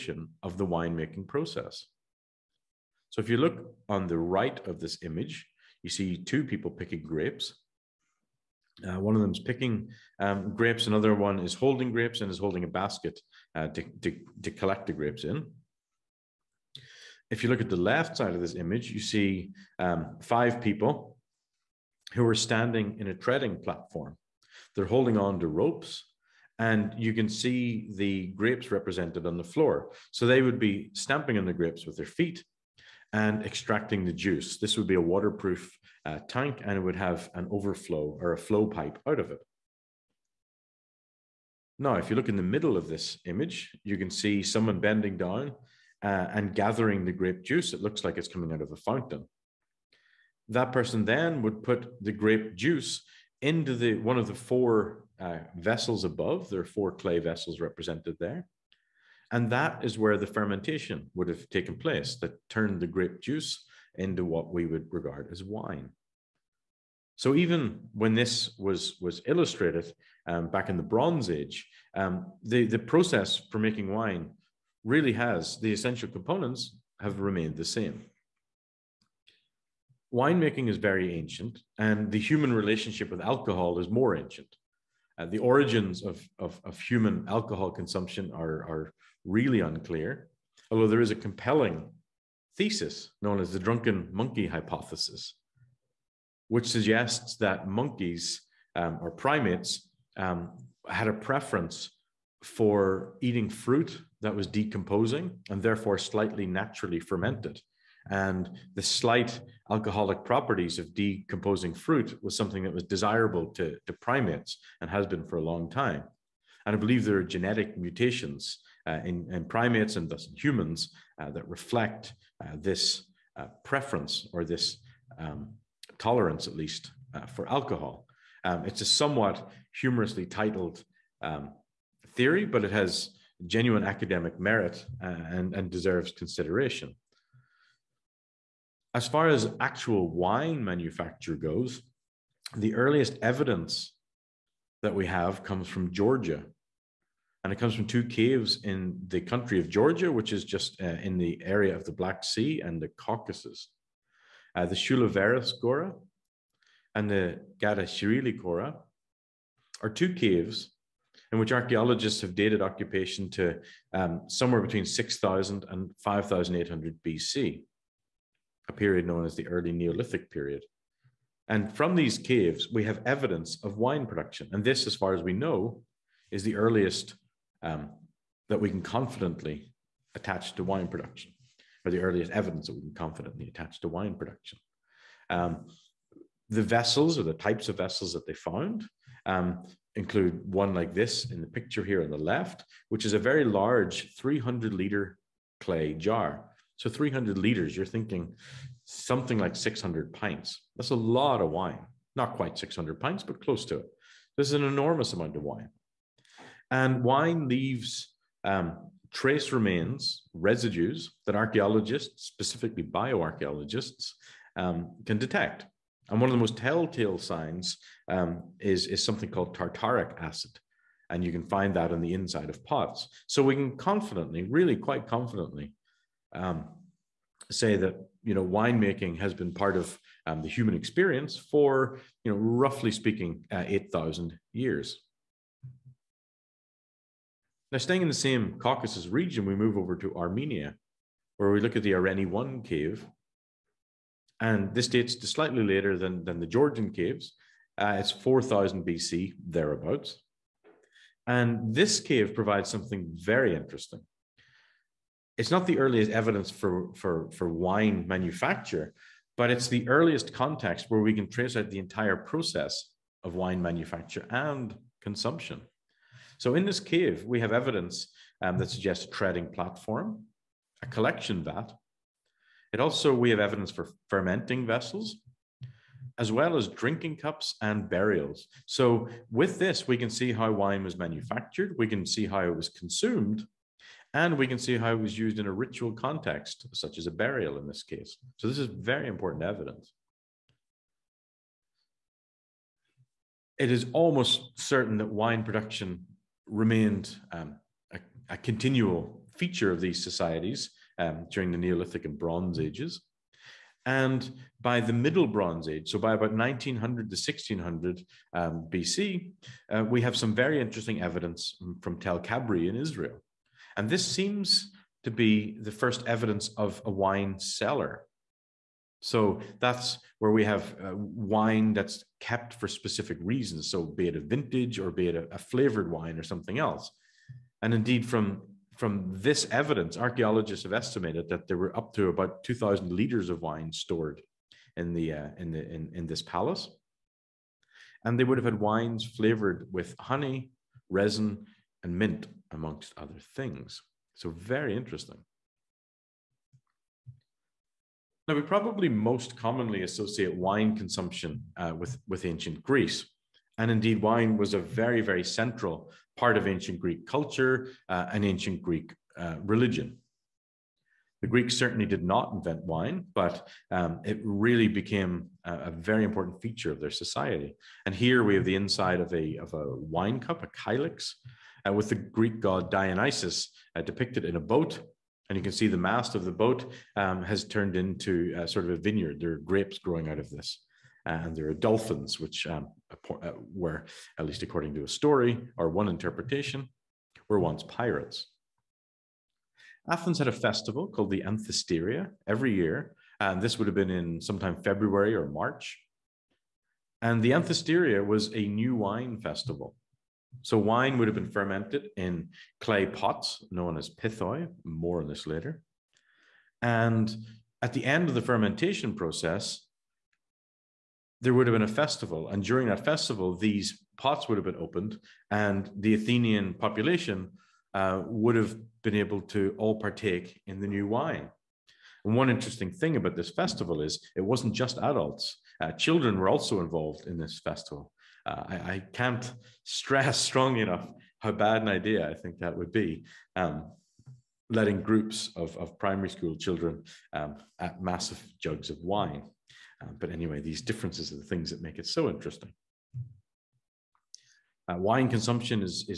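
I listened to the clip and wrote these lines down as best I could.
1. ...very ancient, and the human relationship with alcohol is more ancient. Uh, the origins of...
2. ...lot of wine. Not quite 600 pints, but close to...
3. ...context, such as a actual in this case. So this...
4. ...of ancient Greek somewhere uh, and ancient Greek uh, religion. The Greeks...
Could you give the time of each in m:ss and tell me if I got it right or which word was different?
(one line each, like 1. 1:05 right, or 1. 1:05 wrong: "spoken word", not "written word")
1. 1:20 right
2. 3:20 right
3. 4:45 wrong: "burial", not "actual"
4. 5:56 wrong: "culture", not "somewhere".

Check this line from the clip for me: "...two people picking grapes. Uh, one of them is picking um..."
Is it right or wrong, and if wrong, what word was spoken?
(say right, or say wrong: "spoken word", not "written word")
right.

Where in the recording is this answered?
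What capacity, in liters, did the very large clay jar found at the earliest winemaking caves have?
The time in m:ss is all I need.
3:14.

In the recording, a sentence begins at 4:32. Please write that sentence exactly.
It also, we have evidence for fermenting vessels, as well as drinking cups and burials.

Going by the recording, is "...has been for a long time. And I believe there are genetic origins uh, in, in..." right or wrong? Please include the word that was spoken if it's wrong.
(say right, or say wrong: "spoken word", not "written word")
wrong: "mutations", not "origins".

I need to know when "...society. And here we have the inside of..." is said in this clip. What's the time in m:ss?
6:06.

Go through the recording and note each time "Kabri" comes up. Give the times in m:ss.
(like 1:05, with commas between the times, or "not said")
5:12.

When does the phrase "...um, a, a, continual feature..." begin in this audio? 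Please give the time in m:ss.
4:57.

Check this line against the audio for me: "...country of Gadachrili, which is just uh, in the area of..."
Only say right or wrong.
wrong.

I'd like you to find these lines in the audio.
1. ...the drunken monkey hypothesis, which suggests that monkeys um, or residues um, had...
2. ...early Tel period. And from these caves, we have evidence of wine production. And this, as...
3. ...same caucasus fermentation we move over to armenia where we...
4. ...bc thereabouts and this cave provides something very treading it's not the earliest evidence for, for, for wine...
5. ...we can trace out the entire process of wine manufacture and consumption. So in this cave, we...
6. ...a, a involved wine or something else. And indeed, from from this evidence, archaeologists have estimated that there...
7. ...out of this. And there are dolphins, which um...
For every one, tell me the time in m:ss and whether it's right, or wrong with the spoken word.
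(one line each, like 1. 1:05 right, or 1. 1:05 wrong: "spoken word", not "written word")
1. 1:33 wrong: "primates", not "residues"
2. 2:49 wrong: "Neolithic", not "Tel"
3. 3:58 wrong: "region", not "fermentation"
4. 4:08 wrong: "interesting", not "treading"
5. 4:21 right
6. 5:25 wrong: "flavored", not "involved"
7. 6:20 right.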